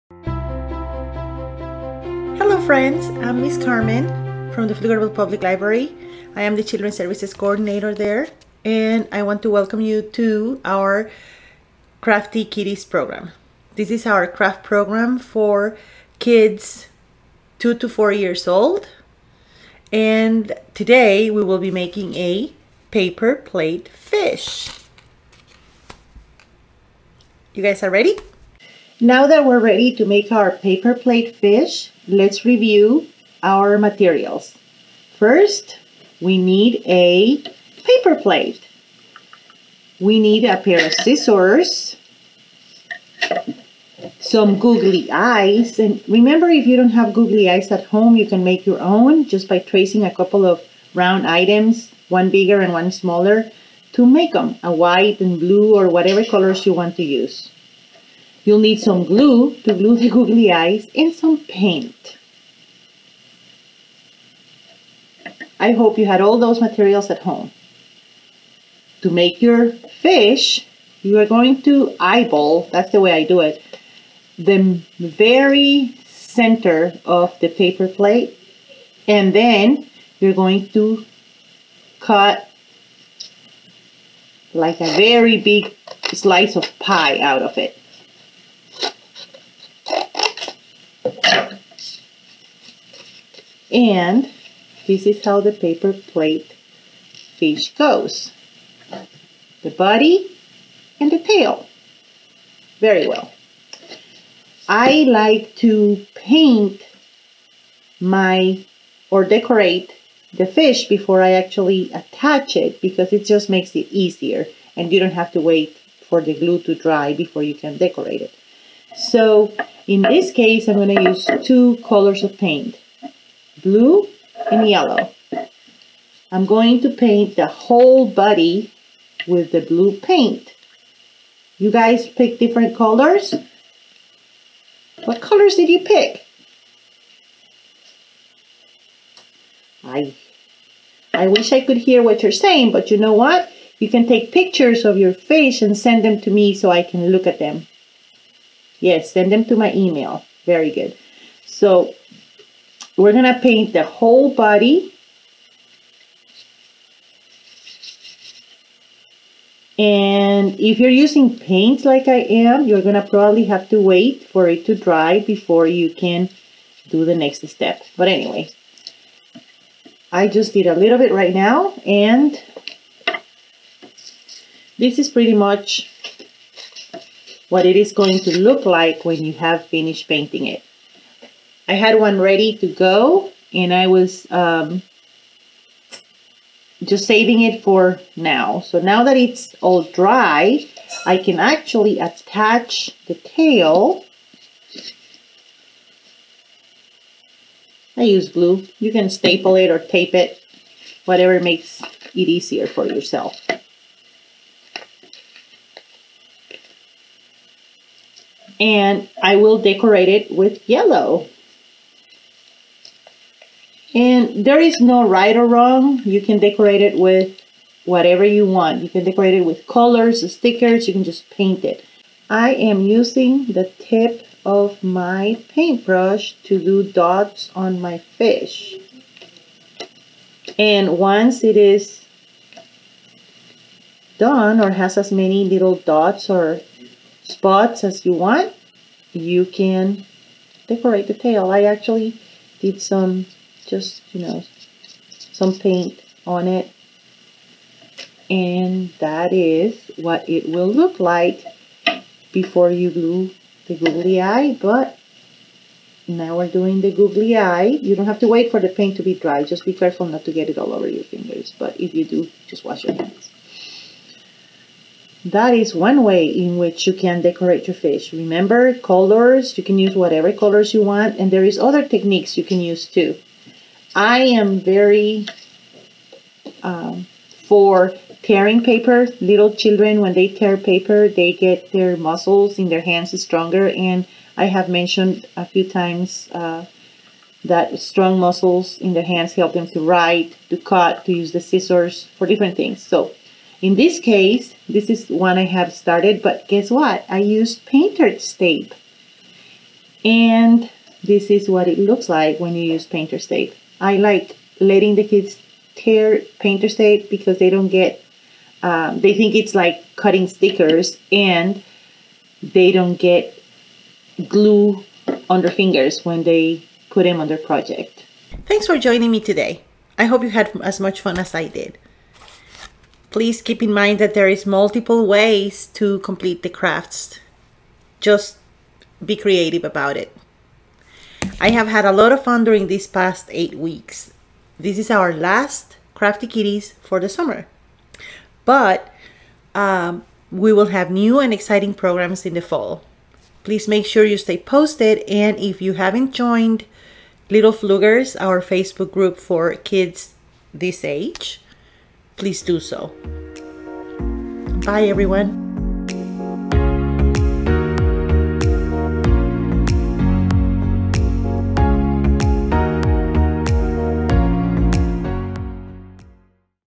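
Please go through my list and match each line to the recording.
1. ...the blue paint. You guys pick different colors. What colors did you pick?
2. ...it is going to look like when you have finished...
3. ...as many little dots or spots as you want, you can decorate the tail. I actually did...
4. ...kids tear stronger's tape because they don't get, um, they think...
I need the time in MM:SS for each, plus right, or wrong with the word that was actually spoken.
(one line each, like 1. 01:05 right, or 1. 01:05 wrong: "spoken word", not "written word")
1. 02:09 right
2. 02:57 right
3. 03:54 right
4. 05:05 wrong: "painter", not "stronger".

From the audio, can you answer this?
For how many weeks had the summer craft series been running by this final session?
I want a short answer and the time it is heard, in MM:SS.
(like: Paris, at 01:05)
8, at 05:33.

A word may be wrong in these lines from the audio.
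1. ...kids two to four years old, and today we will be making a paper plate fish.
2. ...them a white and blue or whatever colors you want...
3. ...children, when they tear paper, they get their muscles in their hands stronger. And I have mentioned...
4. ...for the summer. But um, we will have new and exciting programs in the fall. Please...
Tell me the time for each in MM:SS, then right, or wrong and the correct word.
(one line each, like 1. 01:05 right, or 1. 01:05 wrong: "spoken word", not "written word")
1. 00:16 right
2. 00:54 right
3. 04:39 right
4. 05:36 right.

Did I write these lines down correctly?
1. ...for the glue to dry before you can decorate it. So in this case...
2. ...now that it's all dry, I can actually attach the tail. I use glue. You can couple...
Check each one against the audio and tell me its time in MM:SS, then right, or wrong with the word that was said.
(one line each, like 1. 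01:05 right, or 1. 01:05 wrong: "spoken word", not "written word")
1. 01:56 right
2. 03:08 wrong: "staple", not "couple".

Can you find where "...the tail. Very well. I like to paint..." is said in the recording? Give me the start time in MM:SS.
01:41.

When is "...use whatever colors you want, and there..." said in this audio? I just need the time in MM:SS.
04:29.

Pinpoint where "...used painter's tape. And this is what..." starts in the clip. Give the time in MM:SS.
04:57.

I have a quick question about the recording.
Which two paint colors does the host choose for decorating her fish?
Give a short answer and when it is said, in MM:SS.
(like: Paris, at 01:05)
blue and yellow, at 02:03.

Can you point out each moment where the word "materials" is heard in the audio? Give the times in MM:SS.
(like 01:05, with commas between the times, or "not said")
00:33, 01:06.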